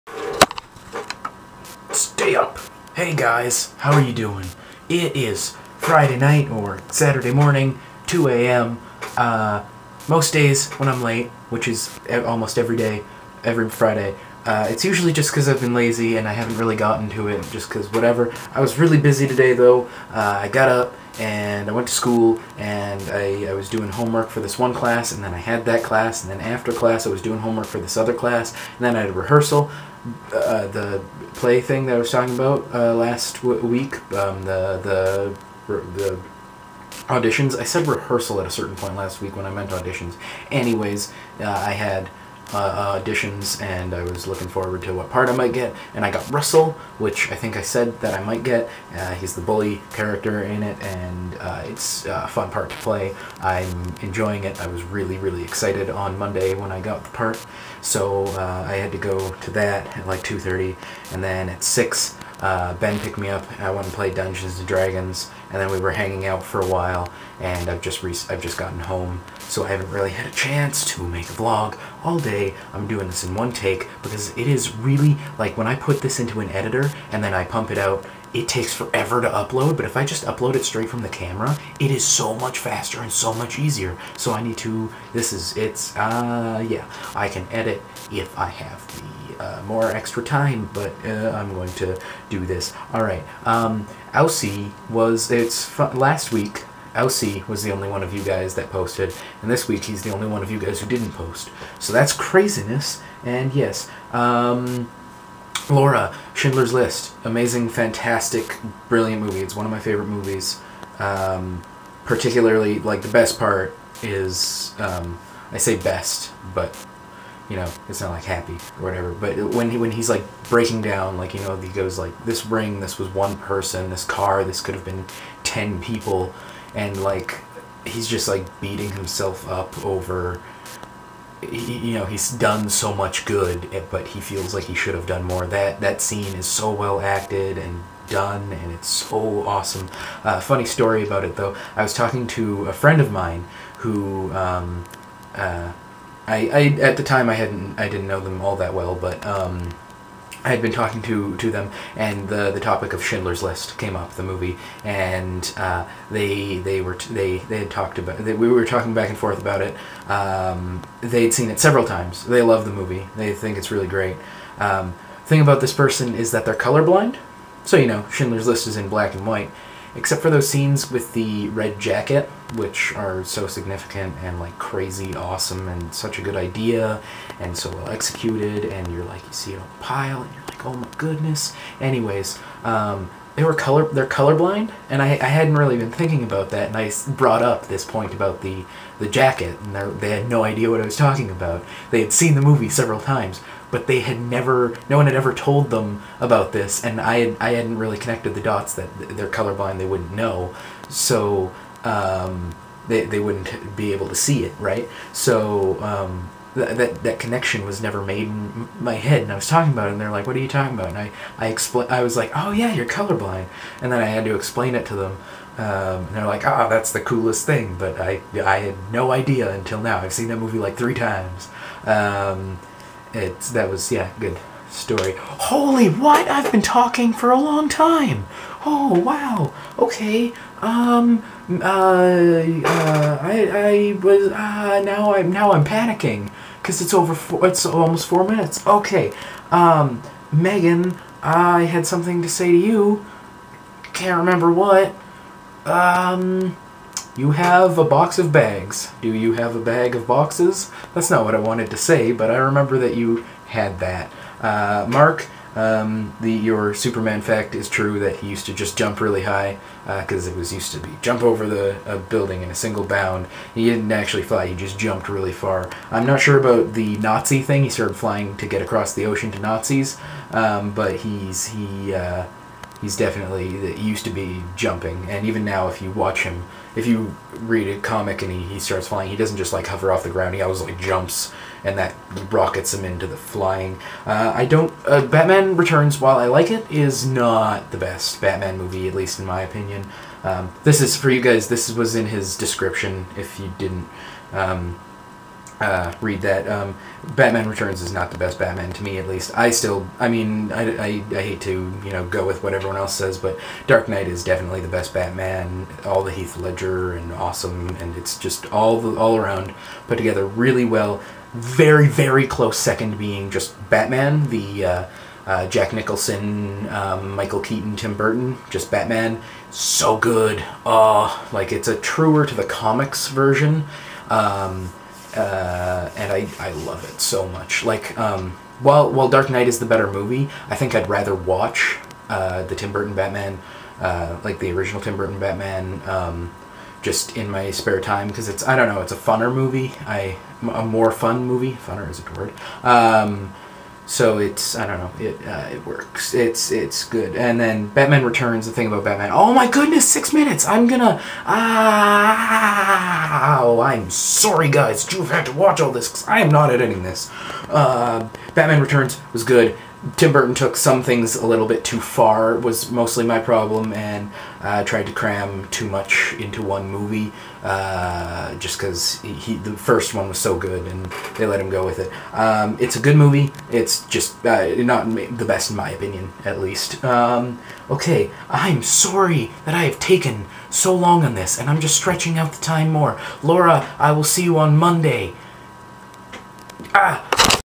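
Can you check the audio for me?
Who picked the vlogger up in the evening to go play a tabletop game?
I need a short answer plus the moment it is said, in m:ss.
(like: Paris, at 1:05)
Ben, at 1:02.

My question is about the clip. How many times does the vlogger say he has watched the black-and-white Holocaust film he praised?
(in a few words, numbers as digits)
3.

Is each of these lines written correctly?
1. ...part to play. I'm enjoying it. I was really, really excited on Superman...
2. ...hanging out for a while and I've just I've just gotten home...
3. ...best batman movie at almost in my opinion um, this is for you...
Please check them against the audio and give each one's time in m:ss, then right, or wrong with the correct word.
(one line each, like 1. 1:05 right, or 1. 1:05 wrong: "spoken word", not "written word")
1. 0:52 wrong: "Monday", not "Superman"
2. 1:05 right
3. 4:47 wrong: "least", not "almost".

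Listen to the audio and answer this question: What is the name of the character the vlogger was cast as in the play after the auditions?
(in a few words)
Russell.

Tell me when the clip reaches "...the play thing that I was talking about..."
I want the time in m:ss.
0:30.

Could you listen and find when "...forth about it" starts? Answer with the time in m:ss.
2:39.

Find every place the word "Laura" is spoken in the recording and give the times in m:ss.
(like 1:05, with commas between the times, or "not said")
1:45, 6:23.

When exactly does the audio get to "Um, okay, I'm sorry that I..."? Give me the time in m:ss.
6:16.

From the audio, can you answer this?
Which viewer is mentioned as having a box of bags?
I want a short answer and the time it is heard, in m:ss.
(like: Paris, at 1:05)
Megan, at 4:00.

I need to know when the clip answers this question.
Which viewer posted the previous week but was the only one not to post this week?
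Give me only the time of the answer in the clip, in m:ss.
1:36.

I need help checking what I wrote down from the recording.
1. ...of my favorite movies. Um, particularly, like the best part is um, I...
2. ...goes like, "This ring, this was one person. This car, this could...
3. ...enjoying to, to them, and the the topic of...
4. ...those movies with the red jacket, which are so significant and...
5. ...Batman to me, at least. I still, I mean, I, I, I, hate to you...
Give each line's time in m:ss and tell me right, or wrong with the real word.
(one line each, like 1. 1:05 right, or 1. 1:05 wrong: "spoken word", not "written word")
1. 1:49 right
2. 2:01 right
3. 2:30 wrong: "talking", not "enjoying"
4. 2:50 wrong: "scenes", not "movies"
5. 4:58 right.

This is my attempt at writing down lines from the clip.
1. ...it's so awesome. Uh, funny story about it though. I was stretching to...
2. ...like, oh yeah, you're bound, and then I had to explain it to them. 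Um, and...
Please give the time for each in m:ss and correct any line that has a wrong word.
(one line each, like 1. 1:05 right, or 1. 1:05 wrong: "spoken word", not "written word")
1. 2:18 wrong: "talking", not "stretching"
2. 3:32 wrong: "colorblind", not "bound".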